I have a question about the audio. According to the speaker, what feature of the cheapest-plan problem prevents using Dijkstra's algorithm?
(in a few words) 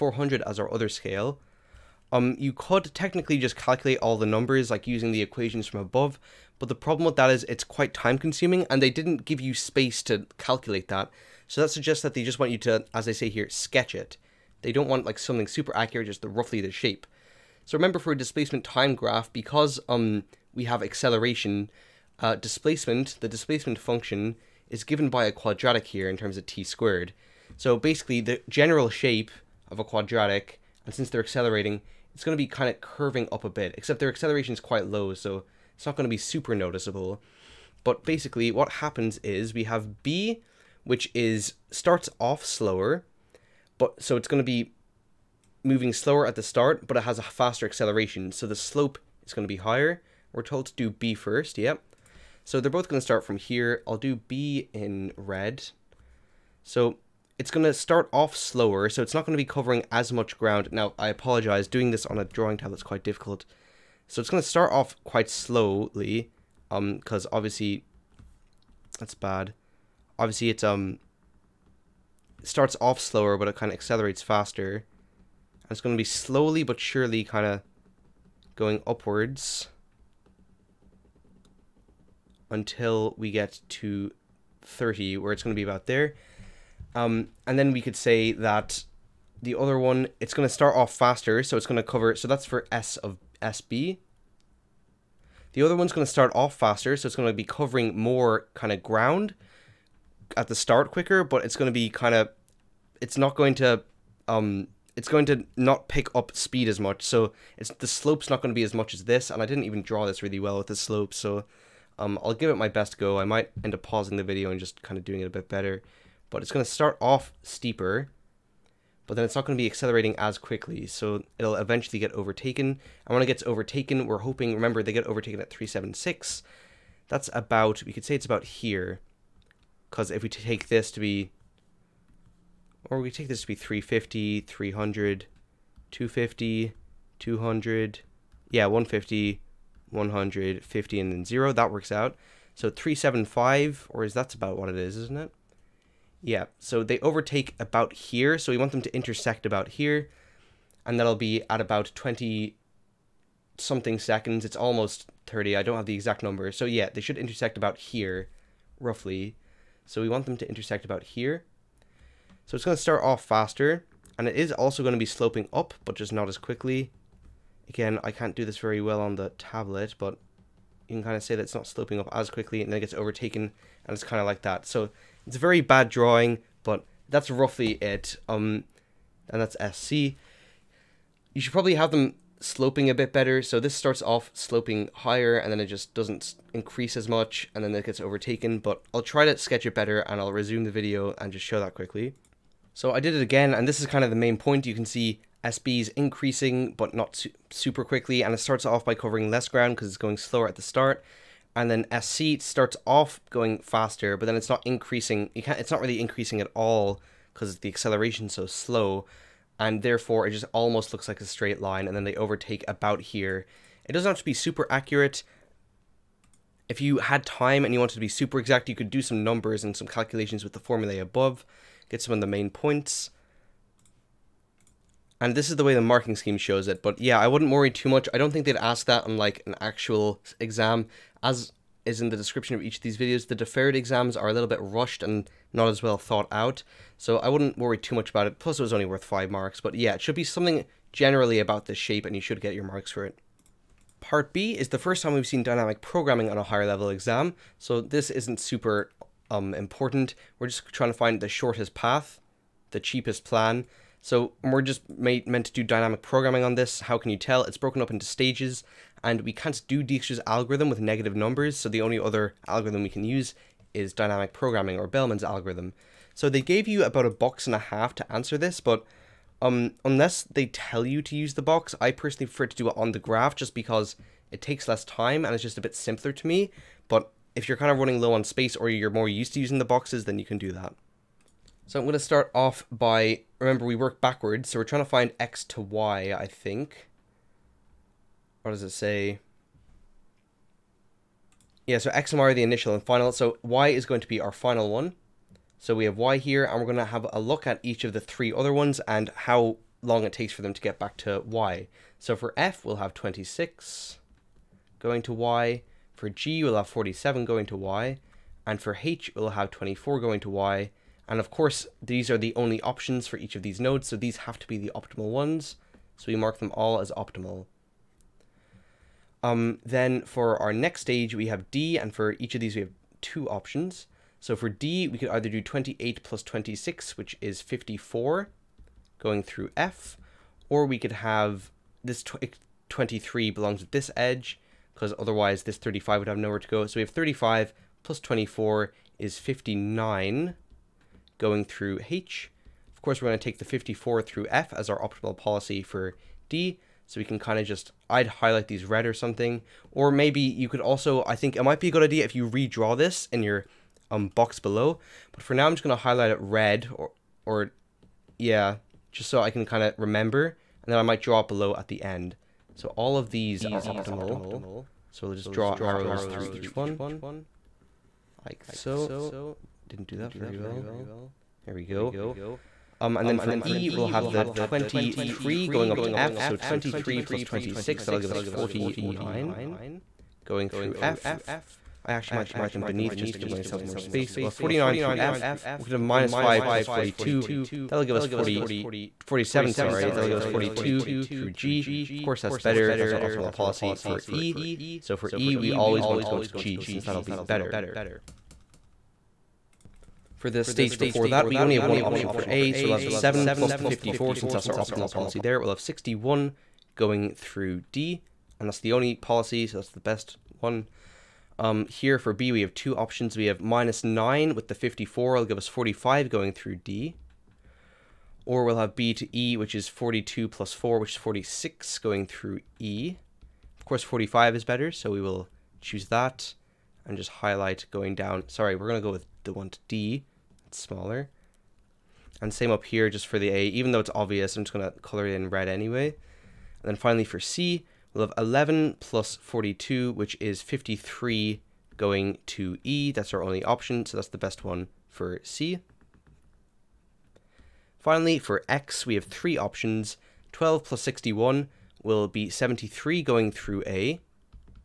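Negative numbers.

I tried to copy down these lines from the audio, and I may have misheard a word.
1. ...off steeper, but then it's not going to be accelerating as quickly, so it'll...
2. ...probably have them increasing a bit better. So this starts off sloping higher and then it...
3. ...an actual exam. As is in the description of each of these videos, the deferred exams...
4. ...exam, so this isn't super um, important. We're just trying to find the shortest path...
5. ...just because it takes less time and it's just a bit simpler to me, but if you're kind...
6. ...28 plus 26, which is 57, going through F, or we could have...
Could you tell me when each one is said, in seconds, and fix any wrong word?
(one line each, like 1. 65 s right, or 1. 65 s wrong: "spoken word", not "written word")
1. 116 s right
2. 181 s wrong: "sloping", not "increasing"
3. 229 s right
4. 246 s right
5. 273 s right
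6. 325 s wrong: "54", not "57".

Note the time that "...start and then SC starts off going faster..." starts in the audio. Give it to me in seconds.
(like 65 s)
200 s.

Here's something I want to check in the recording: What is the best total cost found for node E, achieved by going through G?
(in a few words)
42.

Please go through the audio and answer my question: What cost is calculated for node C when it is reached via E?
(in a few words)
53.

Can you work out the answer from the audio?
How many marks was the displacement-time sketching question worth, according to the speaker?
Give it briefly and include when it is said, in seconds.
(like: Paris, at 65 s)
5, at 239 s.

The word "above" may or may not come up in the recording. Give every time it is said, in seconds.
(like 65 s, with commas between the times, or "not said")
5 s, 220 s.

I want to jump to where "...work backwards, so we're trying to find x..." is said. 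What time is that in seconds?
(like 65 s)
283 s.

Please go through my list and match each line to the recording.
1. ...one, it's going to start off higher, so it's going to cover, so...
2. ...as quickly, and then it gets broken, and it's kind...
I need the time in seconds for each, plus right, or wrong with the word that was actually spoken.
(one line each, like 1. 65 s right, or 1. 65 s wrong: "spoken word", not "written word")
1. 89 s wrong: "faster", not "higher"
2. 172 s wrong: "overtaken", not "broken".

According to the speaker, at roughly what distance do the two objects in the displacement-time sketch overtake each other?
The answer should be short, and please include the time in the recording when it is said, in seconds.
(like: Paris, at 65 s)
376, at 125 s.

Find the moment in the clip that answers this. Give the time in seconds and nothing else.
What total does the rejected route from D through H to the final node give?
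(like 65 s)
339 s.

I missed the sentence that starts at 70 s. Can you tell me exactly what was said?
Obviously, it's, um, it starts off slower, but it kind of accelerates faster.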